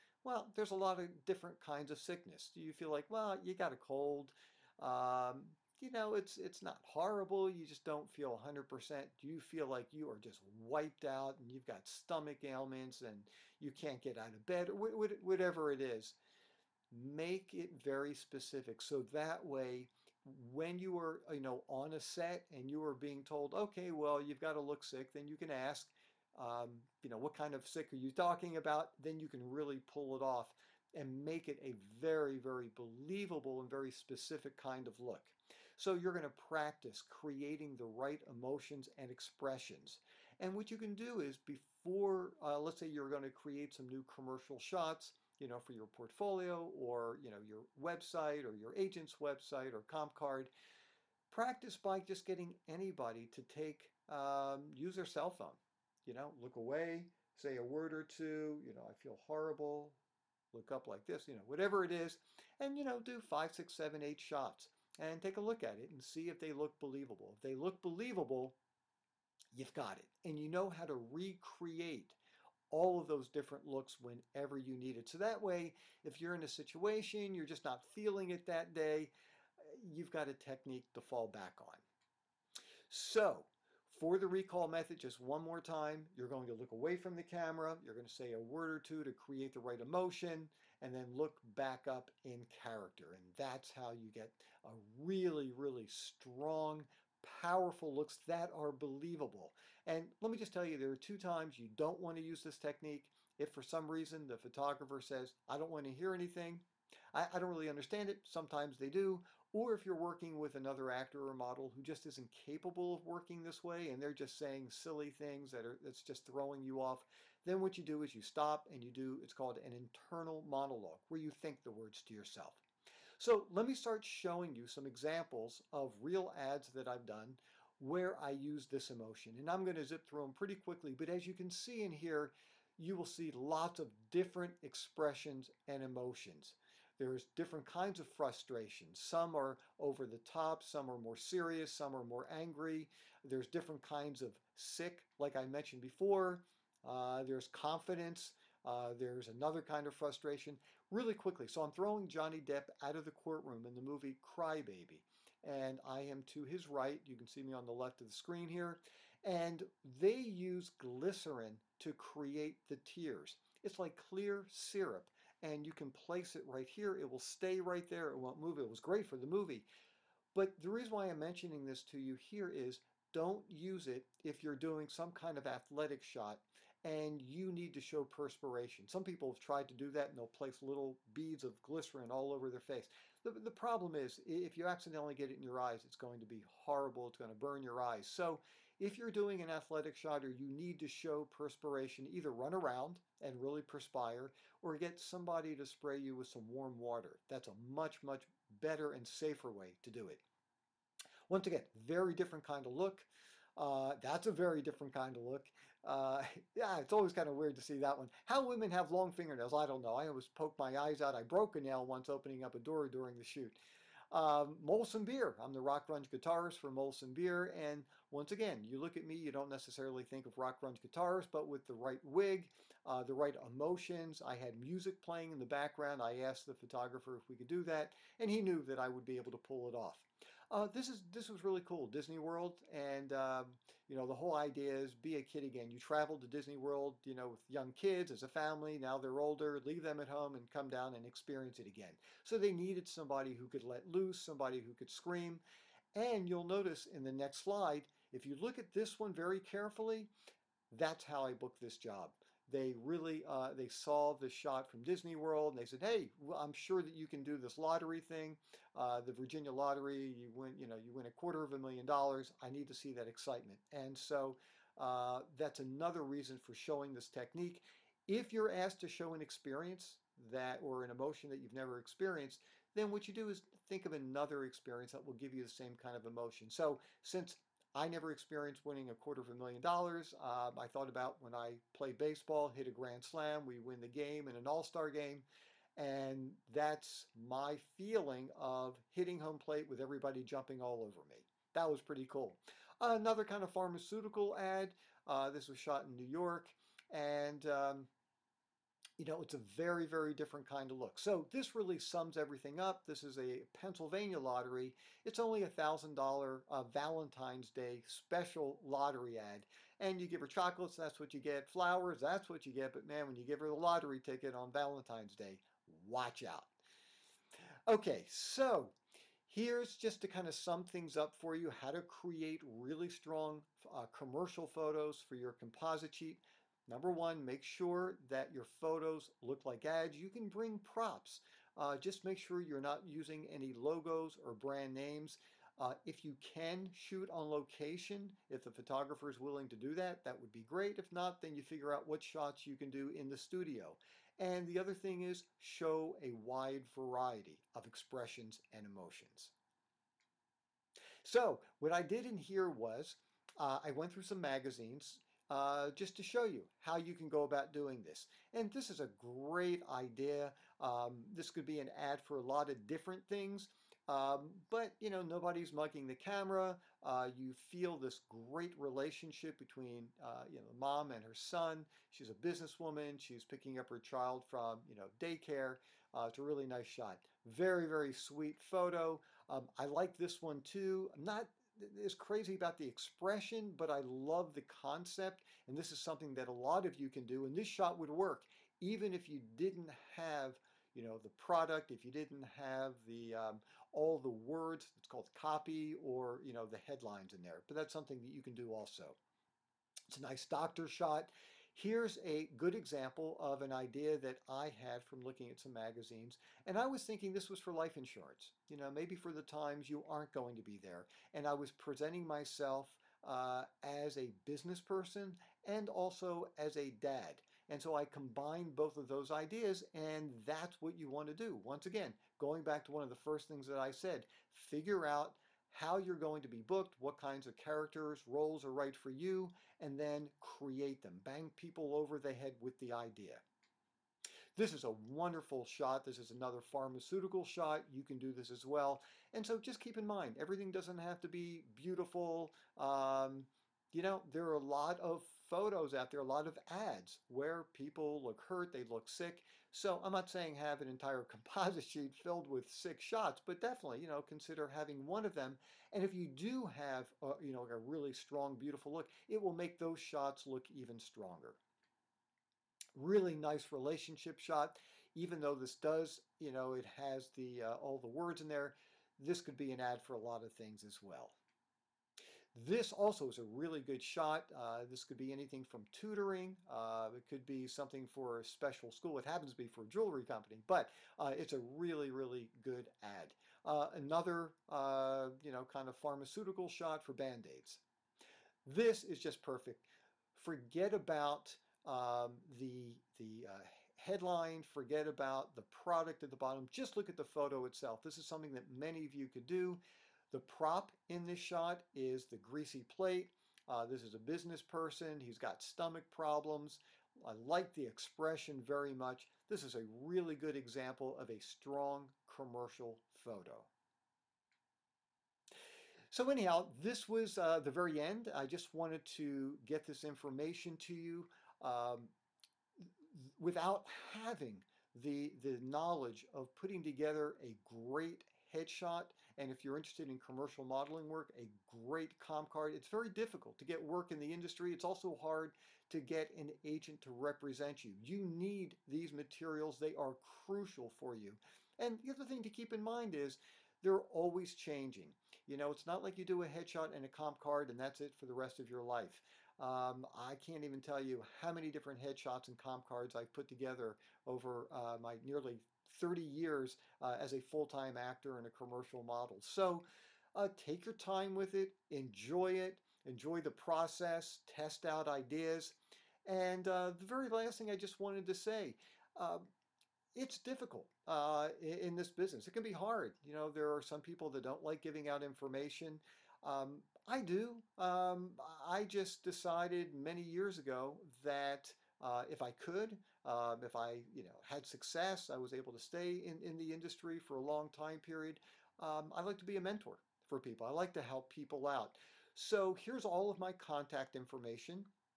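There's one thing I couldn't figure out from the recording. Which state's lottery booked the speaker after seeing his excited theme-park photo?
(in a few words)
Virginia.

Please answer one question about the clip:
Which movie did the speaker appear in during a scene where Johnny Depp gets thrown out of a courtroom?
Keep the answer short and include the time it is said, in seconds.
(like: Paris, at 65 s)
Cry-Baby, at 154 s.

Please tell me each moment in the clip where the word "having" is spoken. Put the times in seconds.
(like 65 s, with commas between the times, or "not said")
454 s, 523 s.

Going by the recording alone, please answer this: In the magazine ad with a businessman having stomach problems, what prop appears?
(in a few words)
Greasy plate.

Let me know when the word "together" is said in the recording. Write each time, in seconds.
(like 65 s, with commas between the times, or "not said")
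526 s, 553 s.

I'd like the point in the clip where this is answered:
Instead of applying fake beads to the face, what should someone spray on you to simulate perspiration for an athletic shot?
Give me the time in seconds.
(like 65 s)
196 s.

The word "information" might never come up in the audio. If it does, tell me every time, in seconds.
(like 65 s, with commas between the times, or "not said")
519 s, 575 s, 593 s.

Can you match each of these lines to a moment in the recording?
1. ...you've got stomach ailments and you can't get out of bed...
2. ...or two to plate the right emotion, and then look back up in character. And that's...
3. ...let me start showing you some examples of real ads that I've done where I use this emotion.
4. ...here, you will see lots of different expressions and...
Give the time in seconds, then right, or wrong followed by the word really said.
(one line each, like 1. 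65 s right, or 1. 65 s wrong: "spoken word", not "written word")
1. 11 s right
2. 88 s wrong: "create", not "plate"
3. 123 s right
4. 131 s right.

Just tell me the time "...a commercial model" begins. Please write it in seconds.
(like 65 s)
558 s.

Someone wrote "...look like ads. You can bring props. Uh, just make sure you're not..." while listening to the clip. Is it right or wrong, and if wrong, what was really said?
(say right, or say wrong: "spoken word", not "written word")
right.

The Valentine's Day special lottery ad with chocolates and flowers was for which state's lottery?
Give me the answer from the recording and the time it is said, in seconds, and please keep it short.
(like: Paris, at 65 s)
Pennsylvania, at 303 s.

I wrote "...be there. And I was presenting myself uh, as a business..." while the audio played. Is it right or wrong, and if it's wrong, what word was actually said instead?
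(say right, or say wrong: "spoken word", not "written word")
right.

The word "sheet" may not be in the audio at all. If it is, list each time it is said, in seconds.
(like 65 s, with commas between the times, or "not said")
325 s, 451 s.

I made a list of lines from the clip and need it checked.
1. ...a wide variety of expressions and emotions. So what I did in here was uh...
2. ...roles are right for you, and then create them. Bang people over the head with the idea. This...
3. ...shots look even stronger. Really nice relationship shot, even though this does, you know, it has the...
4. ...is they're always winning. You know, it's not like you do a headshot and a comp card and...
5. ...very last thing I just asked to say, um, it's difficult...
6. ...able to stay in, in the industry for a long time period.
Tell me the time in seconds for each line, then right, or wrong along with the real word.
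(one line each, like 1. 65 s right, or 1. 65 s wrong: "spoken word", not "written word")
1. 346 s right
2. 428 s right
3. 459 s right
4. 542 s wrong: "changing", not "winning"
5. 566 s wrong: "wanted", not "asked"
6. 585 s right.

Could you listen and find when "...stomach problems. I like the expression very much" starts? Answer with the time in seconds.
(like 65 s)
505 s.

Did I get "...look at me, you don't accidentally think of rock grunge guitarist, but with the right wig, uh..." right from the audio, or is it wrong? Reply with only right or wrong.
wrong.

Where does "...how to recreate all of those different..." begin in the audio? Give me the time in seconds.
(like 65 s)
70 s.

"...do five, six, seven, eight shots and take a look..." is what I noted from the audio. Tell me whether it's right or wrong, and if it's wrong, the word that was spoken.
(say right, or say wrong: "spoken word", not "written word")
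right.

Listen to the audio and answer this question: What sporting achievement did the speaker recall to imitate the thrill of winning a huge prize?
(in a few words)
Grand slam.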